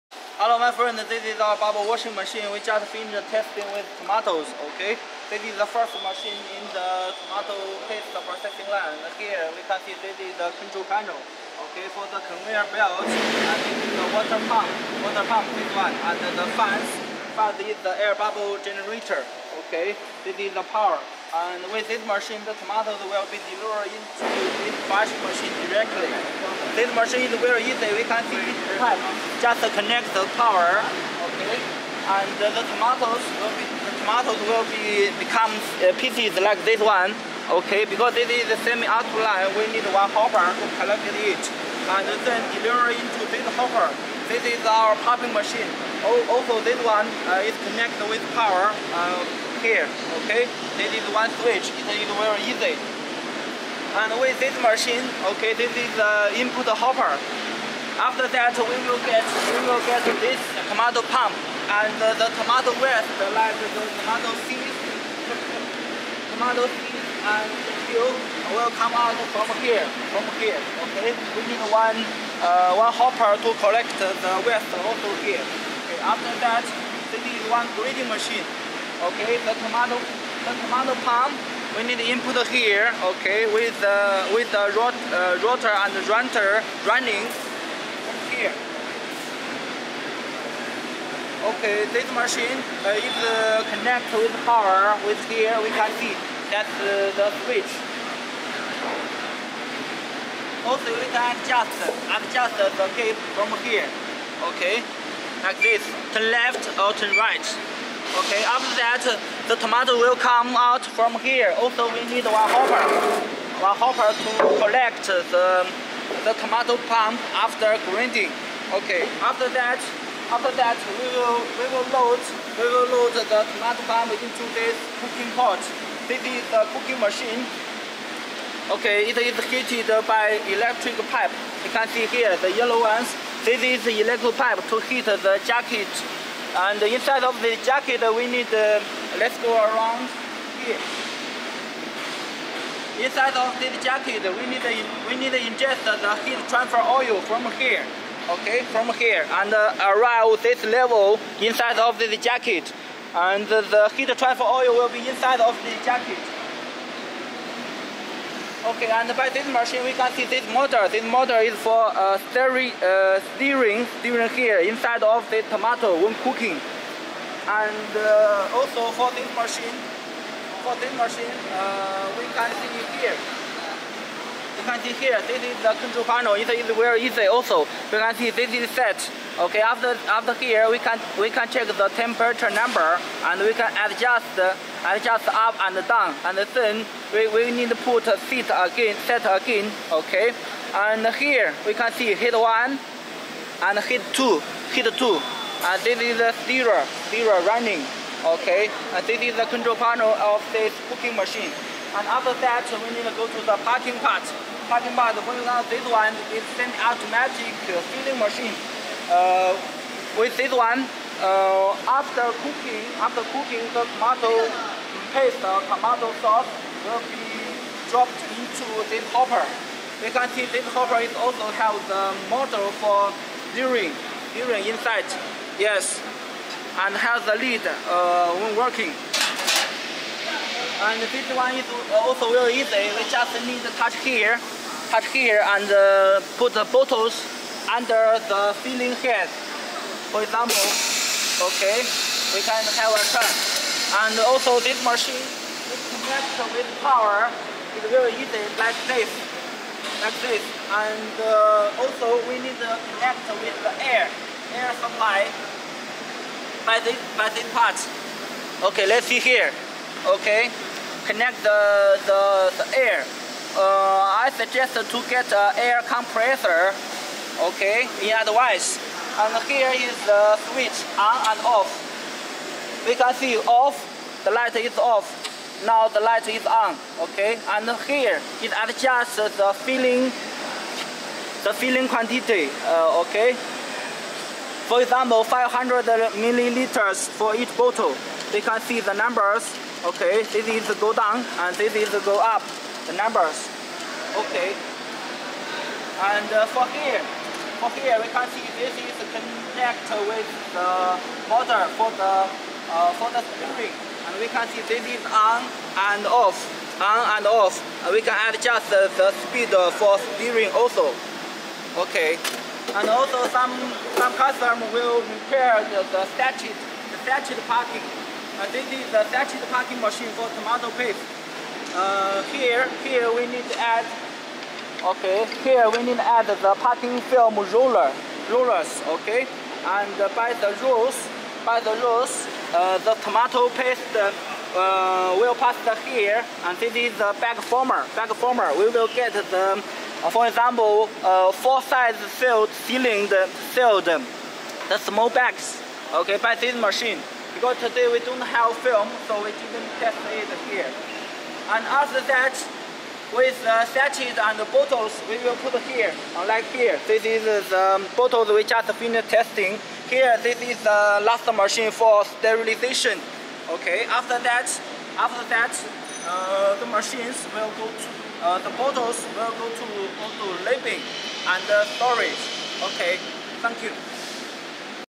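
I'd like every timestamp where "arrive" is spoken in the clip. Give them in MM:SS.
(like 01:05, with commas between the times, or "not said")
02:29.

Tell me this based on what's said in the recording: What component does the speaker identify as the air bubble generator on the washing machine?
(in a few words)
Fans.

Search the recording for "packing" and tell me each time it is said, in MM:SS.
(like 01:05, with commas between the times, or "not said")
05:19, 05:26.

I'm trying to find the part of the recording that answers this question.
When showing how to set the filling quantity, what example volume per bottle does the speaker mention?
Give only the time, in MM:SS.
04:45.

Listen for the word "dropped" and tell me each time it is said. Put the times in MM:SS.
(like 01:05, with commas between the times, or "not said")
03:37.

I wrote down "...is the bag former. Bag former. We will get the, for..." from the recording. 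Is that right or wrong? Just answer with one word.
right.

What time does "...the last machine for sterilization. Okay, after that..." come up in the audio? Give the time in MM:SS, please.
06:00.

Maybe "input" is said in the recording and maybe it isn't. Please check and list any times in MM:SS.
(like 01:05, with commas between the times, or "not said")
00:56, 01:21.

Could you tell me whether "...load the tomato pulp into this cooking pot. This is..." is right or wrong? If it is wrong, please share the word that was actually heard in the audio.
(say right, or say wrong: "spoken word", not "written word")
right.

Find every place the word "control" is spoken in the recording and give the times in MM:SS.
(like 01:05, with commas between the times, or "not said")
00:10, 02:55, 03:19.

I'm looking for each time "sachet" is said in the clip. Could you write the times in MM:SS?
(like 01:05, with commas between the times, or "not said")
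05:19, 05:53.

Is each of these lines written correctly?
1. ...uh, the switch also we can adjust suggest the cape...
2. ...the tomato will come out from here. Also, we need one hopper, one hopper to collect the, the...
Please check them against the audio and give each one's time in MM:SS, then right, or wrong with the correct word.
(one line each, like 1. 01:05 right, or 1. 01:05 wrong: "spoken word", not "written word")
1. 01:36 wrong: "adjust", not "suggest"
2. 01:49 right.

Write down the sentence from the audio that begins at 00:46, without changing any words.
Also, this one uh, is connected with power.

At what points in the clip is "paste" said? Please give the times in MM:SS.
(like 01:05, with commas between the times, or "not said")
00:07, 03:35, 05:20, 05:33.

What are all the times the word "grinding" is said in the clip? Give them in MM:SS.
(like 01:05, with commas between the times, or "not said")
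01:17, 01:57.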